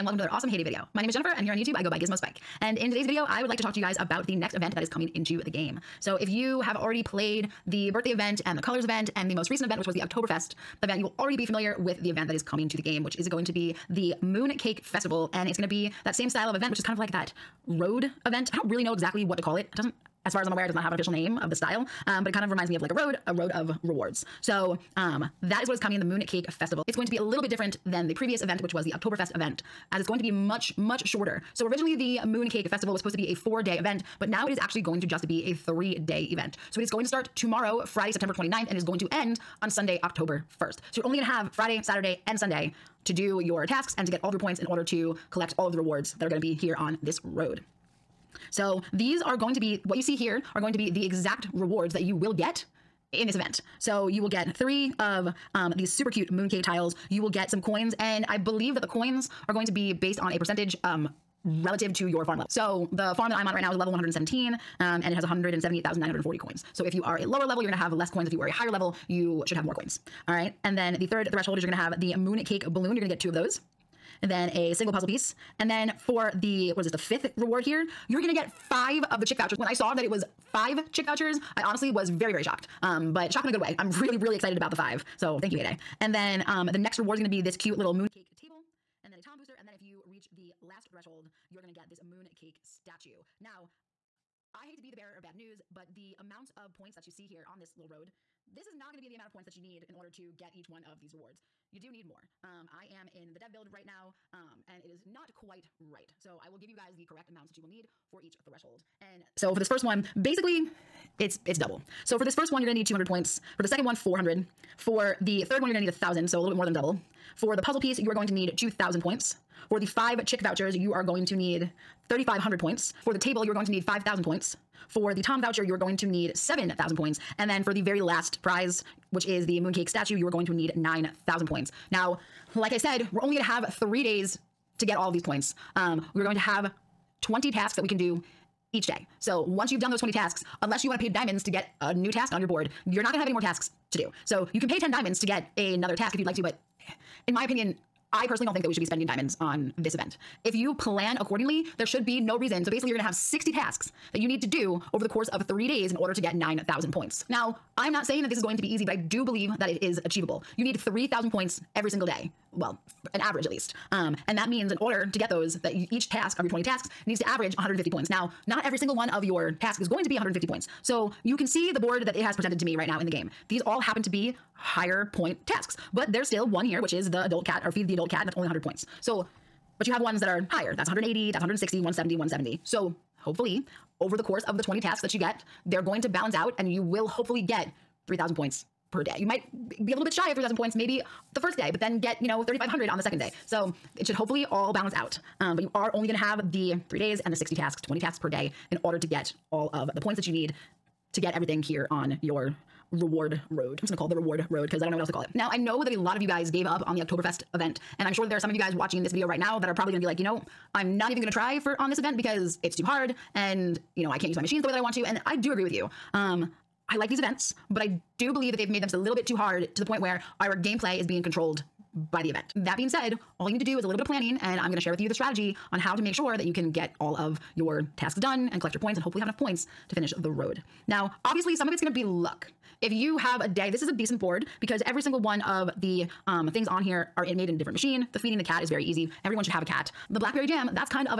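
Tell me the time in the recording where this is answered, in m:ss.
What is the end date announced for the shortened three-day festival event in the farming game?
0:40.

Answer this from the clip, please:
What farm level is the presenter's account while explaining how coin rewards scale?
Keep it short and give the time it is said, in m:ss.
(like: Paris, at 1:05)
117, at 1:03.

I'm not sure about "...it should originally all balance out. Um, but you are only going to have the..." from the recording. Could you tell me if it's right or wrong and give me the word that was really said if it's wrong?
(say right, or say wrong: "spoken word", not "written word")
wrong: "hopefully", not "originally".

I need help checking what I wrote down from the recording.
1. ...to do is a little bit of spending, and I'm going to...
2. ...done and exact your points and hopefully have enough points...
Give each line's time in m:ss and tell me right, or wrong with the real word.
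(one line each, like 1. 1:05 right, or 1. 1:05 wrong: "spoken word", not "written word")
1. 3:43 wrong: "planning", not "spending"
2. 3:48 wrong: "collect", not "exact".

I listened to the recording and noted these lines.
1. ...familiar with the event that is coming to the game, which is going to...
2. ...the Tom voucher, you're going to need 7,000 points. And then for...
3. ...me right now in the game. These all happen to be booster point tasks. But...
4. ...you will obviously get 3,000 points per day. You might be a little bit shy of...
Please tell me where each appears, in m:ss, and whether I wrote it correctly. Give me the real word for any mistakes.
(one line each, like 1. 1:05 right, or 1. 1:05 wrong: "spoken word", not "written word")
1. 0:11 right
2. 2:05 right
3. 2:52 wrong: "higher", not "booster"
4. 3:06 wrong: "hopefully", not "obviously".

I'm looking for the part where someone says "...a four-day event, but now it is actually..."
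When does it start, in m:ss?
0:33.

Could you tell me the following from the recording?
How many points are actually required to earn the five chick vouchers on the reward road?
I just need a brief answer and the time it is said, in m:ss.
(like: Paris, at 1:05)
3,500, at 2:02.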